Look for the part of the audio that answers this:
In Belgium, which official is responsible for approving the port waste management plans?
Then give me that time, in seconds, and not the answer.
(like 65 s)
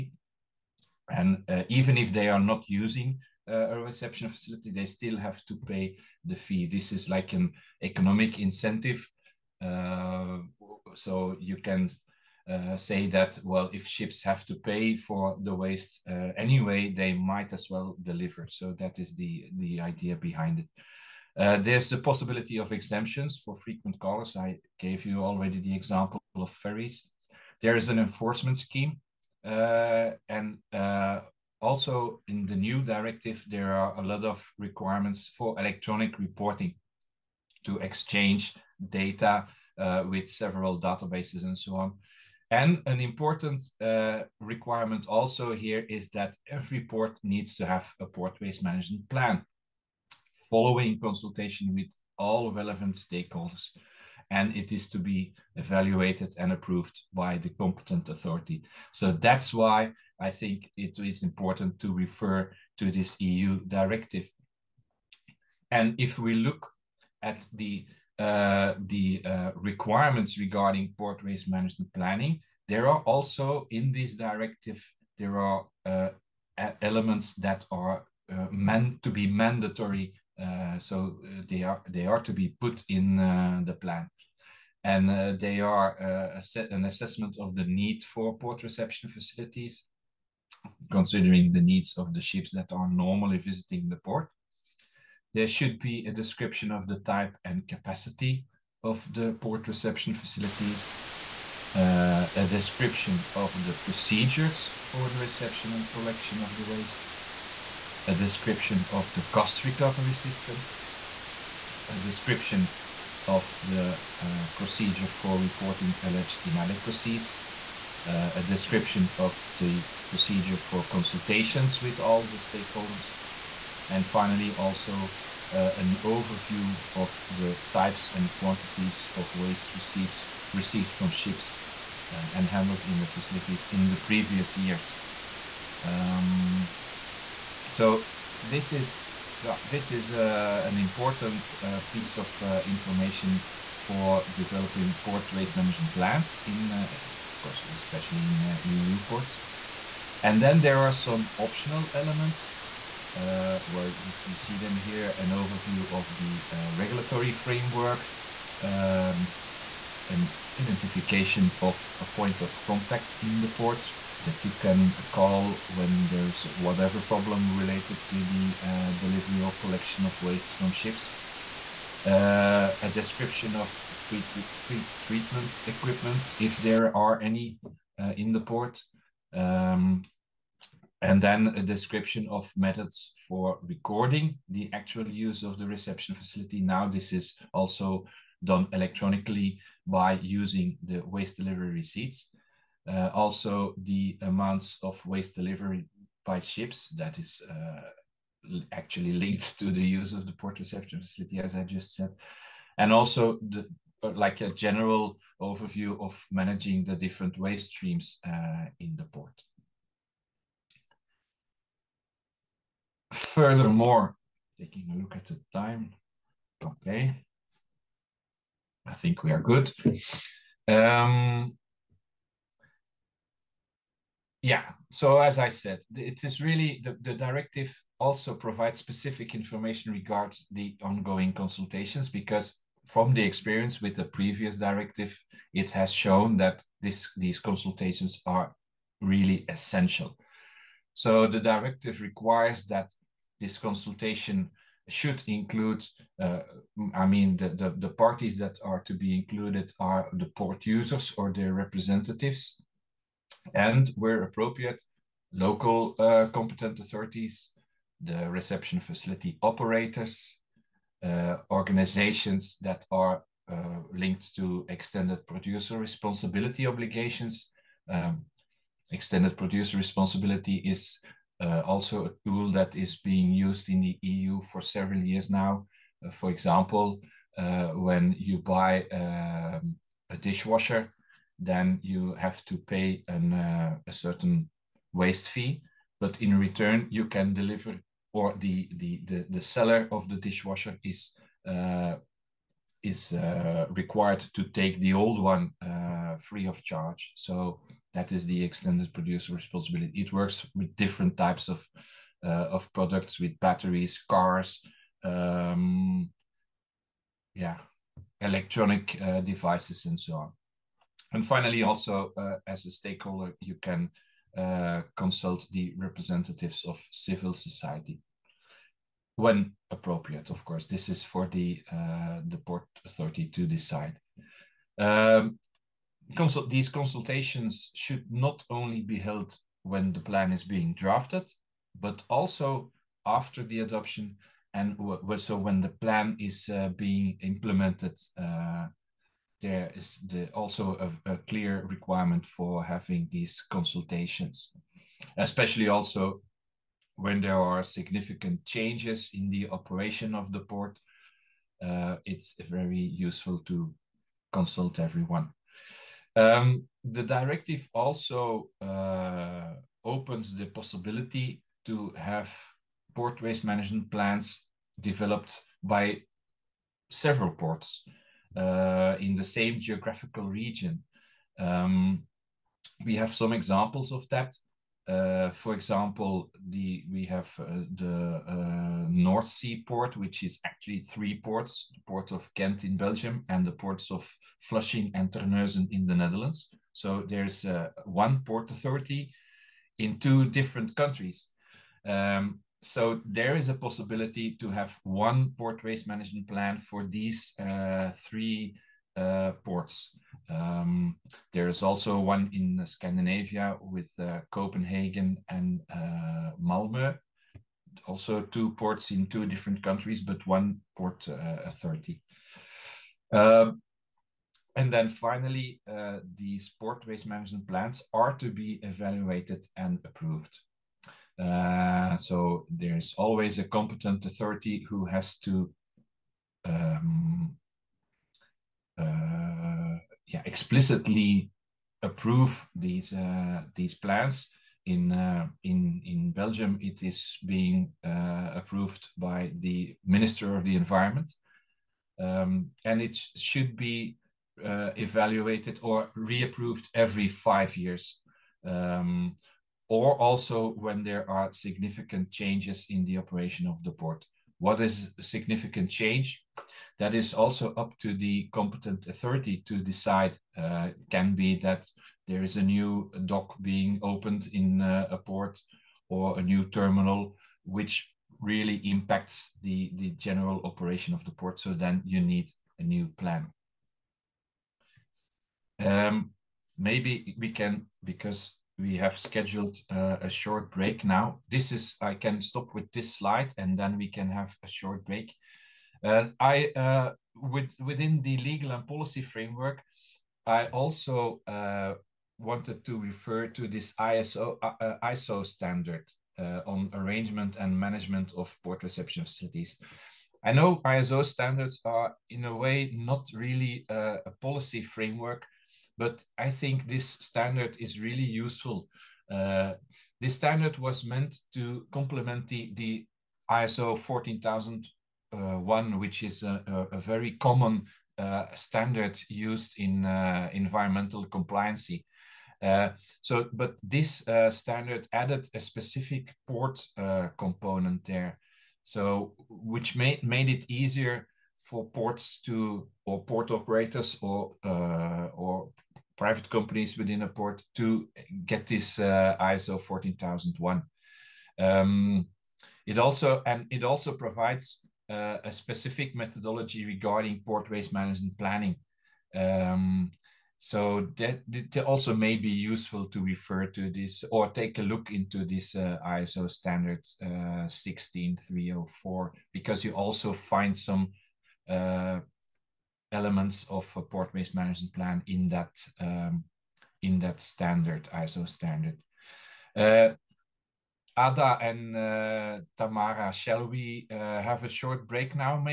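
439 s.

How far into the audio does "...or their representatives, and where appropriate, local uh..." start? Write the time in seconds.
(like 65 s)
251 s.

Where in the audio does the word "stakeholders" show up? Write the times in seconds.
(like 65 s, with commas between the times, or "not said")
52 s, 122 s, 312 s.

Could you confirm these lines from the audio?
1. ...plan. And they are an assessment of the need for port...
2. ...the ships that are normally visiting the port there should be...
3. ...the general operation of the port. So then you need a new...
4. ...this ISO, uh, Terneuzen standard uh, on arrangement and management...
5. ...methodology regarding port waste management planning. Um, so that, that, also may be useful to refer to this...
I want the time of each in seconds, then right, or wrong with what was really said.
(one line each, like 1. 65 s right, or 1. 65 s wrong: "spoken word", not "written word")
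1. 83 s right
2. 92 s right
3. 469 s right
4. 493 s wrong: "ISO", not "Terneuzen"
5. 545 s right.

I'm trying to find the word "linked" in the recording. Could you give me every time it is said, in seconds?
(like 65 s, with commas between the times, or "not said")
199 s, 263 s.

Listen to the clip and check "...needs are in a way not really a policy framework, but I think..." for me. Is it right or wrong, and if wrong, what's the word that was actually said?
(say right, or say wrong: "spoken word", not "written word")
wrong: "standards", not "needs".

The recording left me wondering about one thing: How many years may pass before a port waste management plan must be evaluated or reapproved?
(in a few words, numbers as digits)
5.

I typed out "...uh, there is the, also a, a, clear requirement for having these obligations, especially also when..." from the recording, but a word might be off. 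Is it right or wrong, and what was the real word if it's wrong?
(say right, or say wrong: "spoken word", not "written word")
wrong: "consultations", not "obligations".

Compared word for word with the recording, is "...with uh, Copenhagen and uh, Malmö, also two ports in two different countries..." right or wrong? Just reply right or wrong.
right.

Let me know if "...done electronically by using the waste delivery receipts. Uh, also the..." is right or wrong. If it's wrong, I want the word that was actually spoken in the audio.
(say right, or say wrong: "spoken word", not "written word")
right.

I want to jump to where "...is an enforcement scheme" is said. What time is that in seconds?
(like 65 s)
27 s.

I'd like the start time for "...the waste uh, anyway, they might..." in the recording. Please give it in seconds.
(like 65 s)
15 s.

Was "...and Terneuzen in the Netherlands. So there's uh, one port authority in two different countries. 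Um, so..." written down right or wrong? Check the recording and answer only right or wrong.
right.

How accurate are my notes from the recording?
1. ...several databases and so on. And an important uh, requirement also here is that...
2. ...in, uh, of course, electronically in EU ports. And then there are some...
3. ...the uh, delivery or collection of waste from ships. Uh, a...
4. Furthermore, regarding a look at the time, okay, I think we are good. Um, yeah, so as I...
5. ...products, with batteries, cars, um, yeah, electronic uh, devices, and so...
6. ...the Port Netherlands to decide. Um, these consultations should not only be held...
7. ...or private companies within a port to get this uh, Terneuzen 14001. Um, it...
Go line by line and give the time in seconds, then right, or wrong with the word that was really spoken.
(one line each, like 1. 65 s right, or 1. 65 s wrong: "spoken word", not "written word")
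1. 40 s right
2. 146 s wrong: "especially", not "electronically"
3. 168 s right
4. 213 s wrong: "taking", not "regarding"
5. 302 s right
6. 322 s wrong: "Authority", not "Netherlands"
7. 534 s wrong: "ISO", not "Terneuzen".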